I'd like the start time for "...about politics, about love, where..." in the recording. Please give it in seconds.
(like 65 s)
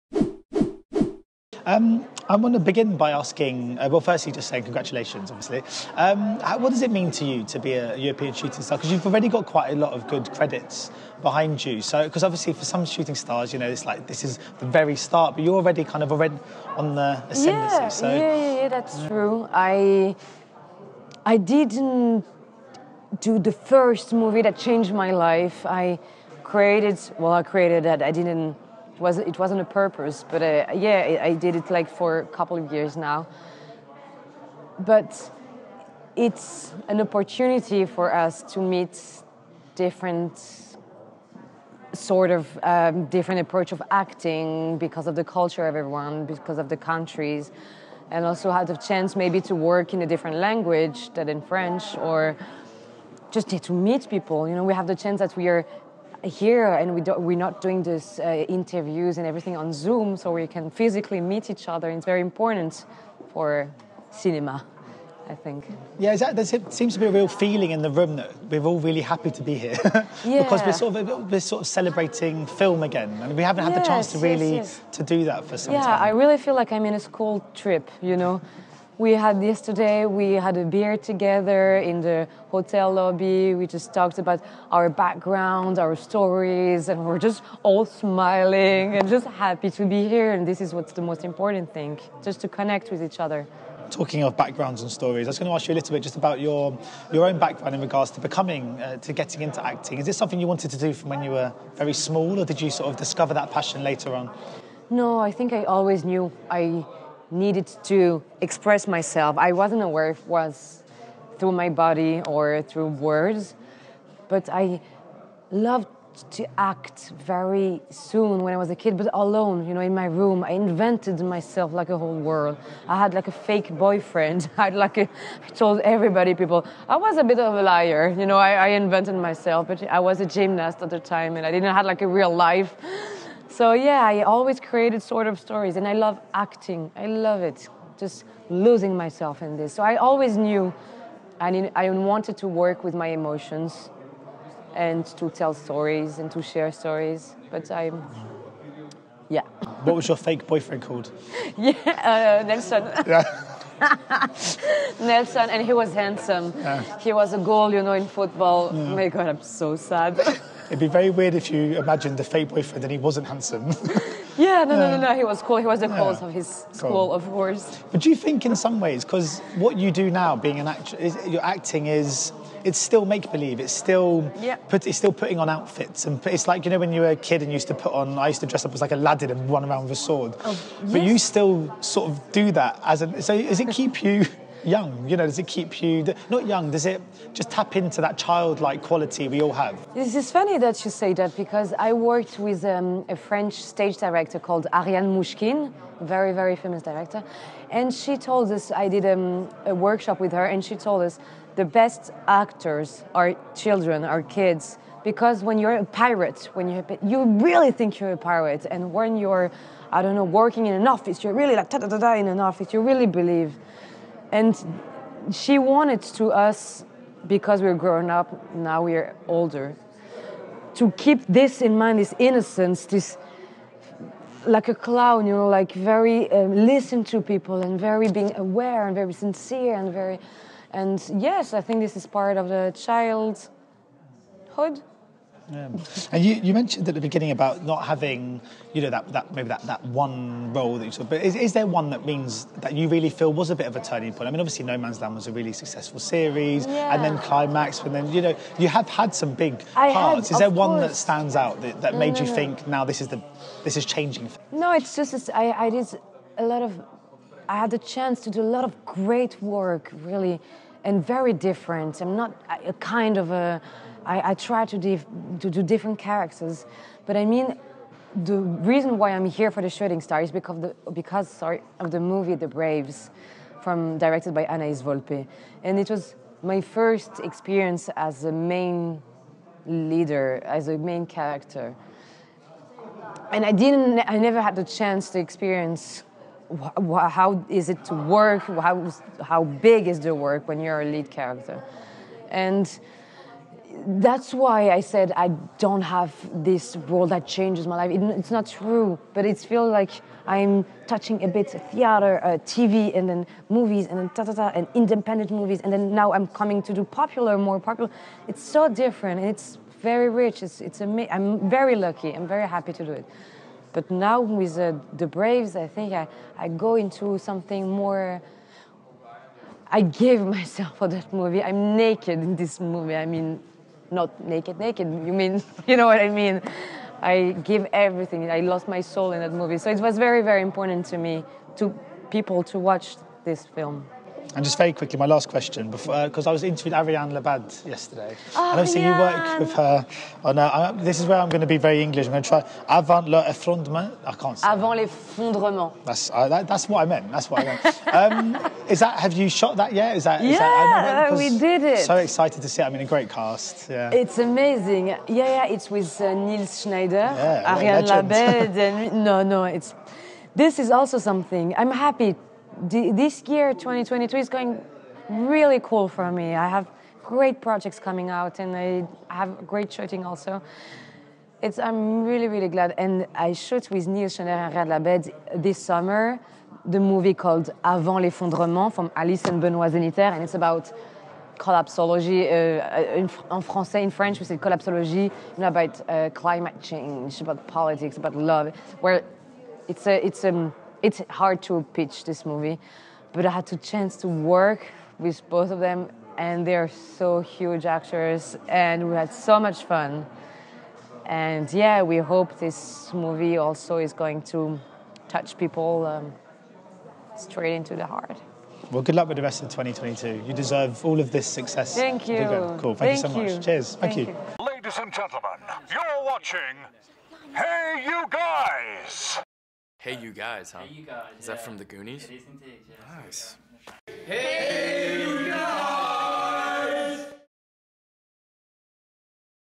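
387 s.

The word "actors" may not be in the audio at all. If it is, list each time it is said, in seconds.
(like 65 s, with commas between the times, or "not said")
170 s, 202 s, 397 s.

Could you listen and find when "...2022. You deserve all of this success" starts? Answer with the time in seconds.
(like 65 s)
409 s.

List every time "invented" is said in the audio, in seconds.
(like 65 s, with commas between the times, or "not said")
120 s, 128 s.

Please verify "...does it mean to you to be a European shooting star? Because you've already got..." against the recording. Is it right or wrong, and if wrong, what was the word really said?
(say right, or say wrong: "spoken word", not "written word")
right.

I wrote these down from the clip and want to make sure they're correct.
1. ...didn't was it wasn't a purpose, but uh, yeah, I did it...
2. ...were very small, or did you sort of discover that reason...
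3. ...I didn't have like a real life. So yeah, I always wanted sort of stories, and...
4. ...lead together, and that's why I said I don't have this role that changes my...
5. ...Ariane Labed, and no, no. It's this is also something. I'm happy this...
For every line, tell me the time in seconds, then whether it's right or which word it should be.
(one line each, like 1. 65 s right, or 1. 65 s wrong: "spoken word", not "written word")
1. 28 s right
2. 101 s wrong: "passion", not "reason"
3. 131 s wrong: "created", not "wanted"
4. 290 s wrong: "character", not "together"
5. 357 s right.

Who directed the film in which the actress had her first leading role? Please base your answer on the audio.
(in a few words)
Anaïs Volpe.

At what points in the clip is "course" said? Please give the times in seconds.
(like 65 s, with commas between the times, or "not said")
167 s, 250 s.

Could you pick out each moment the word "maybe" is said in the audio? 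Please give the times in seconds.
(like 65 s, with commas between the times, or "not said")
49 s, 239 s.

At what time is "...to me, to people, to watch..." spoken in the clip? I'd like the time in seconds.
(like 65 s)
330 s.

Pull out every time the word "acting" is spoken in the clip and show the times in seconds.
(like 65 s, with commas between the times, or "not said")
43 s, 99 s, 136 s, 171 s.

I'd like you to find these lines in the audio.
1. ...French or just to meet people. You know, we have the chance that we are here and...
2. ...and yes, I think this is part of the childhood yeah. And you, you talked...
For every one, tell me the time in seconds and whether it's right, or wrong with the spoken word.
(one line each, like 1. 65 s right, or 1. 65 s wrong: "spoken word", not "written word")
1. 51 s right
2. 230 s wrong: "mentioned", not "talked".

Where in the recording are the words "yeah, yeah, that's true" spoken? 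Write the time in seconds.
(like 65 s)
18 s.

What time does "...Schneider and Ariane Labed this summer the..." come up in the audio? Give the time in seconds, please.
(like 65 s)
374 s.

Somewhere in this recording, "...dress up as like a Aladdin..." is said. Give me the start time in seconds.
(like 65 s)
178 s.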